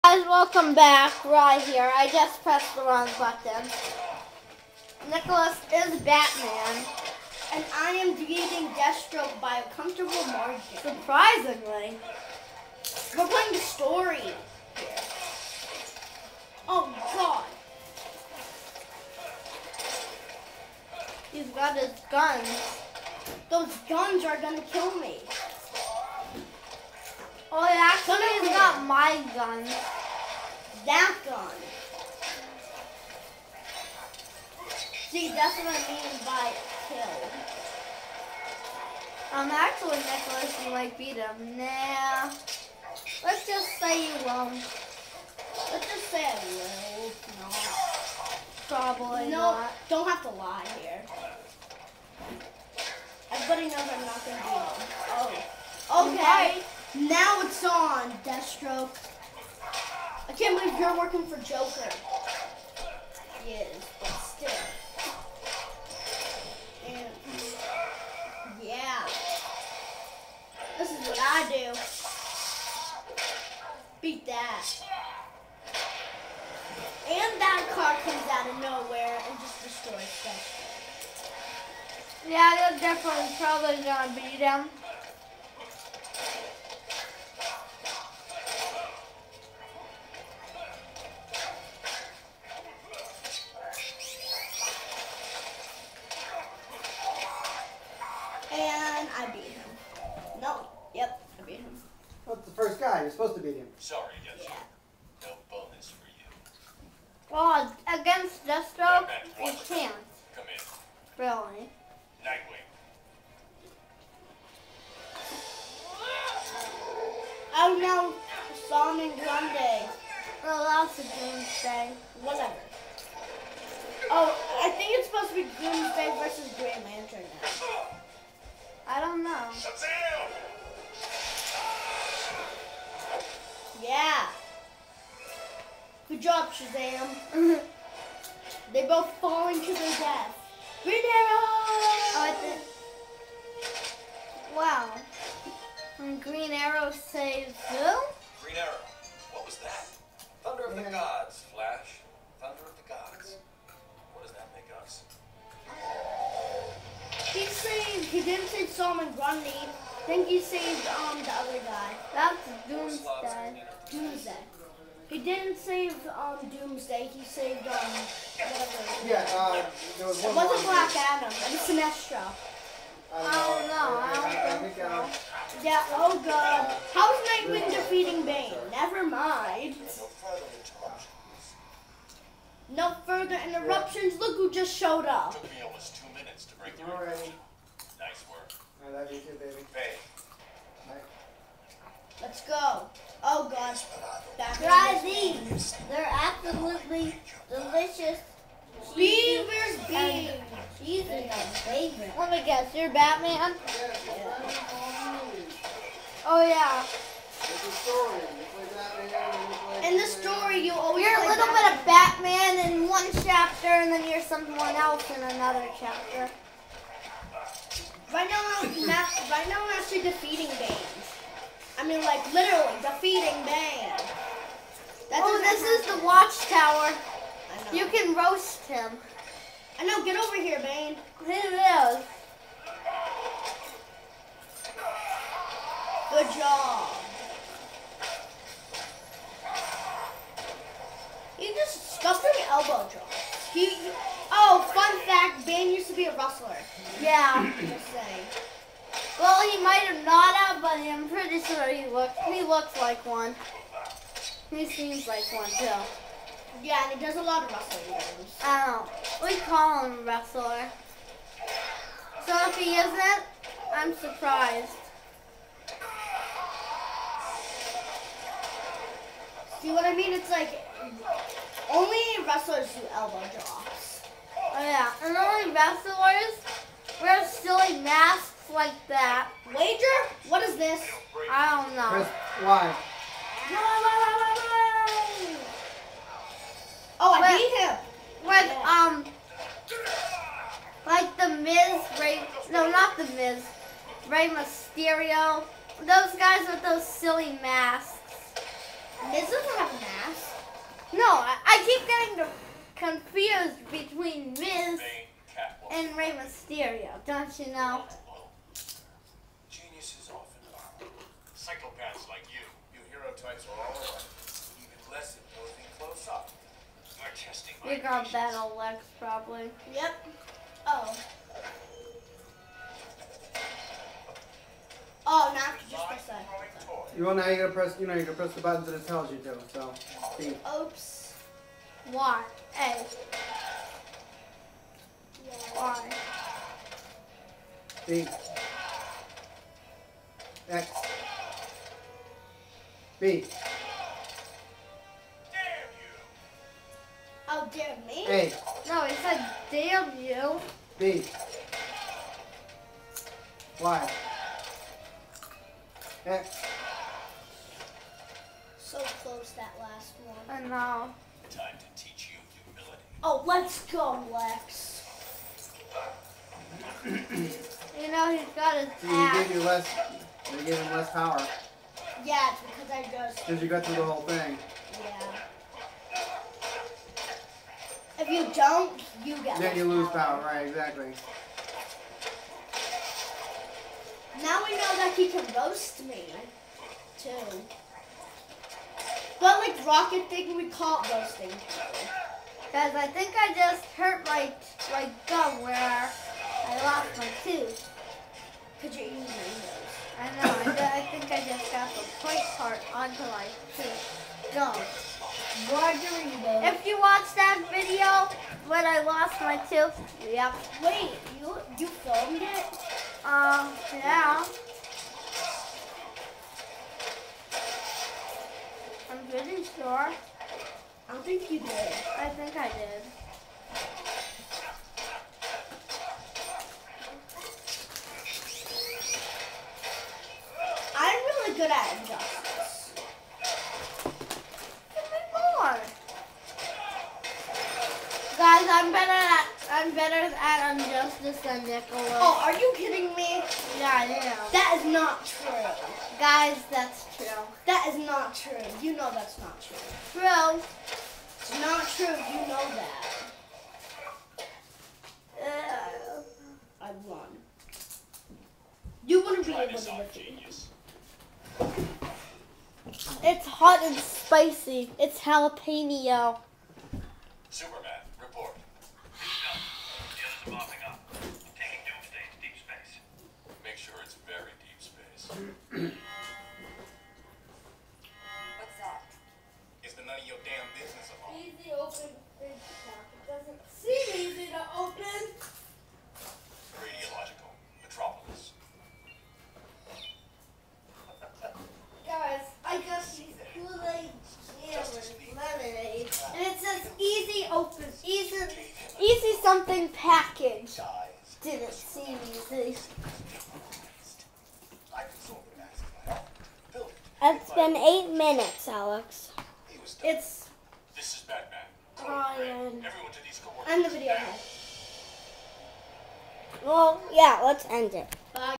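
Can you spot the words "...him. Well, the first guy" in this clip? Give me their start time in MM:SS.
01:41.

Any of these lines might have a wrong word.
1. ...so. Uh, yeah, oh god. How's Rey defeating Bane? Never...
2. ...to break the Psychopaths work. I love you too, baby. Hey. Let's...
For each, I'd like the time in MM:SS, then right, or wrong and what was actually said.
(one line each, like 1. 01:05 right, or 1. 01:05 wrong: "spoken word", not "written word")
1. 02:54 wrong: "Nightwing", not "Rey"
2. 03:06 wrong: "Nice", not "Psychopaths".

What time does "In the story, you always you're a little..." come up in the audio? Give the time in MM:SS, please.
03:29.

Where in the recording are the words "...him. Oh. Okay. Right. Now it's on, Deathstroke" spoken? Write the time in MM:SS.
00:54.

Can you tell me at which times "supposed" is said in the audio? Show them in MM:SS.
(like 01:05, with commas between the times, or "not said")
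01:43, 02:05.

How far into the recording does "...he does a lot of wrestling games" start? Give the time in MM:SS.
04:16.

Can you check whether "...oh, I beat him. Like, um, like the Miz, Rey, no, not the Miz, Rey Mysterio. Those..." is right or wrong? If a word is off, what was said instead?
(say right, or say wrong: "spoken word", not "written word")
right.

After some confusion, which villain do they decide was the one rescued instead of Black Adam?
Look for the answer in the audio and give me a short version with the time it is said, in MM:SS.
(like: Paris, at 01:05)
Sinestro, at 02:51.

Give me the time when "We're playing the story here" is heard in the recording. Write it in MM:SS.
00:13.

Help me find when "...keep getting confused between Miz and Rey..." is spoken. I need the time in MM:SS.
05:01.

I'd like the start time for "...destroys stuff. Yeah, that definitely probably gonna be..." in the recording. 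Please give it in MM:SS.
01:19.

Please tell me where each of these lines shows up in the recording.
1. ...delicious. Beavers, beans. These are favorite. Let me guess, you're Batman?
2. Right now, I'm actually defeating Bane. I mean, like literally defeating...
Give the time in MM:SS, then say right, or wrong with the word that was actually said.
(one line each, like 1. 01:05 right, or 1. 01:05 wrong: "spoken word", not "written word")
1. 03:17 right
2. 03:38 right.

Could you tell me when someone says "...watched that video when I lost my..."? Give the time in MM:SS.
06:46.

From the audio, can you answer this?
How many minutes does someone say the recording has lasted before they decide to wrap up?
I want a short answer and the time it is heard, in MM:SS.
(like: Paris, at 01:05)
8, at 08:27.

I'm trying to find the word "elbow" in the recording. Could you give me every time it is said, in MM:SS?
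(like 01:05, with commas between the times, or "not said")
04:02, 04:32.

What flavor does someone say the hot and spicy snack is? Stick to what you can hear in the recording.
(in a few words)
Jalapeno.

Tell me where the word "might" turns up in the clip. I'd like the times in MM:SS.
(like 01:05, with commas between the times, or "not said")
00:40, 04:09.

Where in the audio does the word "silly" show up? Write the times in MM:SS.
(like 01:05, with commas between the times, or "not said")
04:37, 04:56.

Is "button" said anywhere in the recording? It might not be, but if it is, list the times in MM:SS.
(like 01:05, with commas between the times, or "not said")
00:03, 05:28.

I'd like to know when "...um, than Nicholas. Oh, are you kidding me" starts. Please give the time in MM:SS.
07:21.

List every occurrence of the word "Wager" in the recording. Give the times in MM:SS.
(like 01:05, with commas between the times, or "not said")
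04:39.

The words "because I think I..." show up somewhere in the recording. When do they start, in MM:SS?
06:31.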